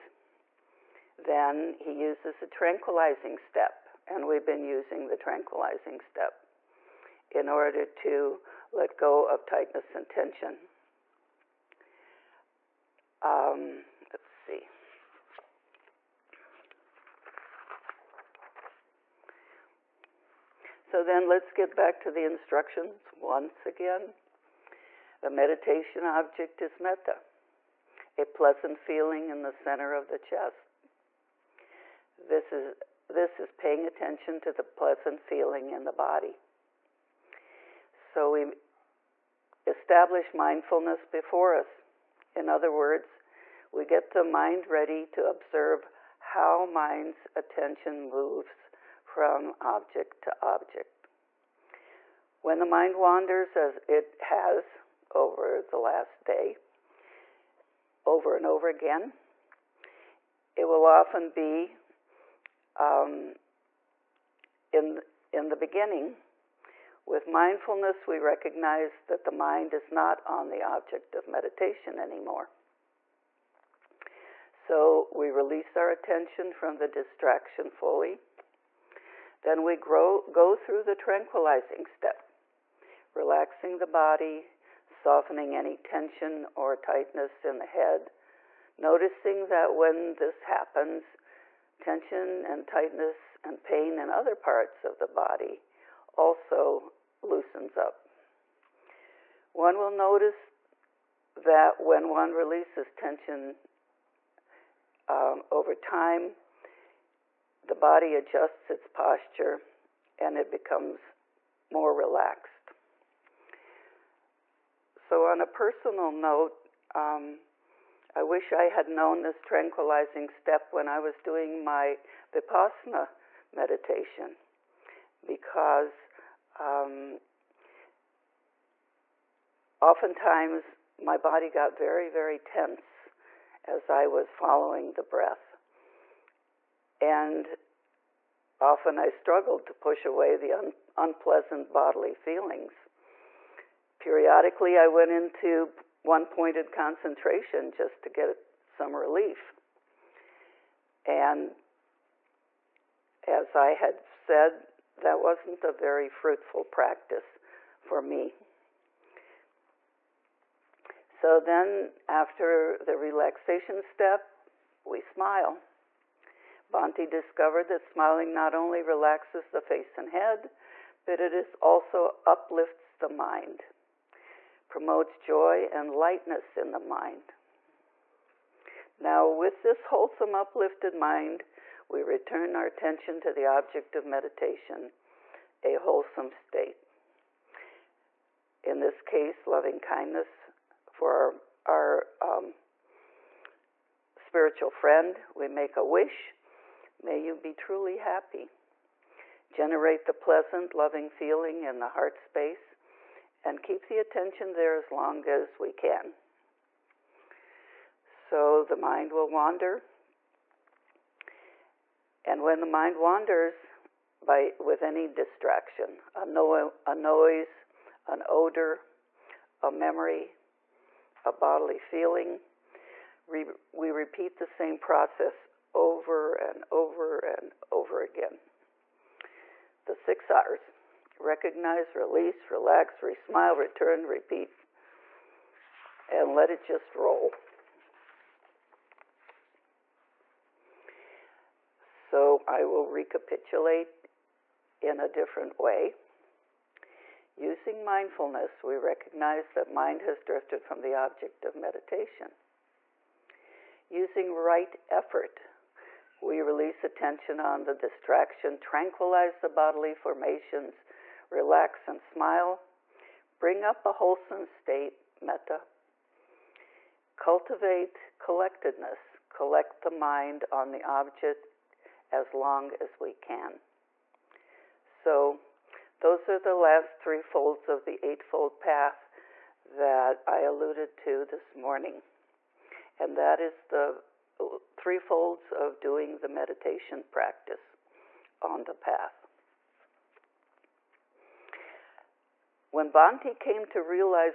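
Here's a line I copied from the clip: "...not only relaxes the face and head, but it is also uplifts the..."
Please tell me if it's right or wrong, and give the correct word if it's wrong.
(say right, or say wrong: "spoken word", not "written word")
right.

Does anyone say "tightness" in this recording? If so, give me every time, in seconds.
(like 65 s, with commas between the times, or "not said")
9 s, 86 s, 92 s.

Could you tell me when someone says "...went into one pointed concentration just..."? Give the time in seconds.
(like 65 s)
144 s.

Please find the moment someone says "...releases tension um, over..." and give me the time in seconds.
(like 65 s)
102 s.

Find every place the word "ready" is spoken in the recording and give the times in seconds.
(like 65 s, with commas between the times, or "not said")
44 s.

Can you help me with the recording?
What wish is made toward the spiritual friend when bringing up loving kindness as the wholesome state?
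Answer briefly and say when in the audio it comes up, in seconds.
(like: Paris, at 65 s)
May you be truly happy, at 197 s.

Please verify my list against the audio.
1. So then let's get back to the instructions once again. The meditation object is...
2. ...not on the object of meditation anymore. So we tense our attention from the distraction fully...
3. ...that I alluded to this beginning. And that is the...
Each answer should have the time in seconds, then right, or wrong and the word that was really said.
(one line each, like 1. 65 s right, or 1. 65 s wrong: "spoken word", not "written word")
1. 20 s right
2. 69 s wrong: "release", not "tense"
3. 279 s wrong: "morning", not "beginning".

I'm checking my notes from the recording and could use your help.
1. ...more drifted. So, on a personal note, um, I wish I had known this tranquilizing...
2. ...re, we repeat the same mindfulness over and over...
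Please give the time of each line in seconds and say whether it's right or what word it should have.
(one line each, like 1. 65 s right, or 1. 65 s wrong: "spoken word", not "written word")
1. 111 s wrong: "relaxed", not "drifted"
2. 223 s wrong: "process", not "mindfulness".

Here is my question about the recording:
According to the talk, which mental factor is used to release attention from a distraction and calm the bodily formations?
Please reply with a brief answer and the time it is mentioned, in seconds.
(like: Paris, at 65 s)
Right effort, at 254 s.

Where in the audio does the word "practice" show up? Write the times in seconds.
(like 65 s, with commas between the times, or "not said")
156 s, 287 s.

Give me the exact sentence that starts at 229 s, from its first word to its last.
The six R's recognize, release, relax, re smile, return, repeat, and let it just roll.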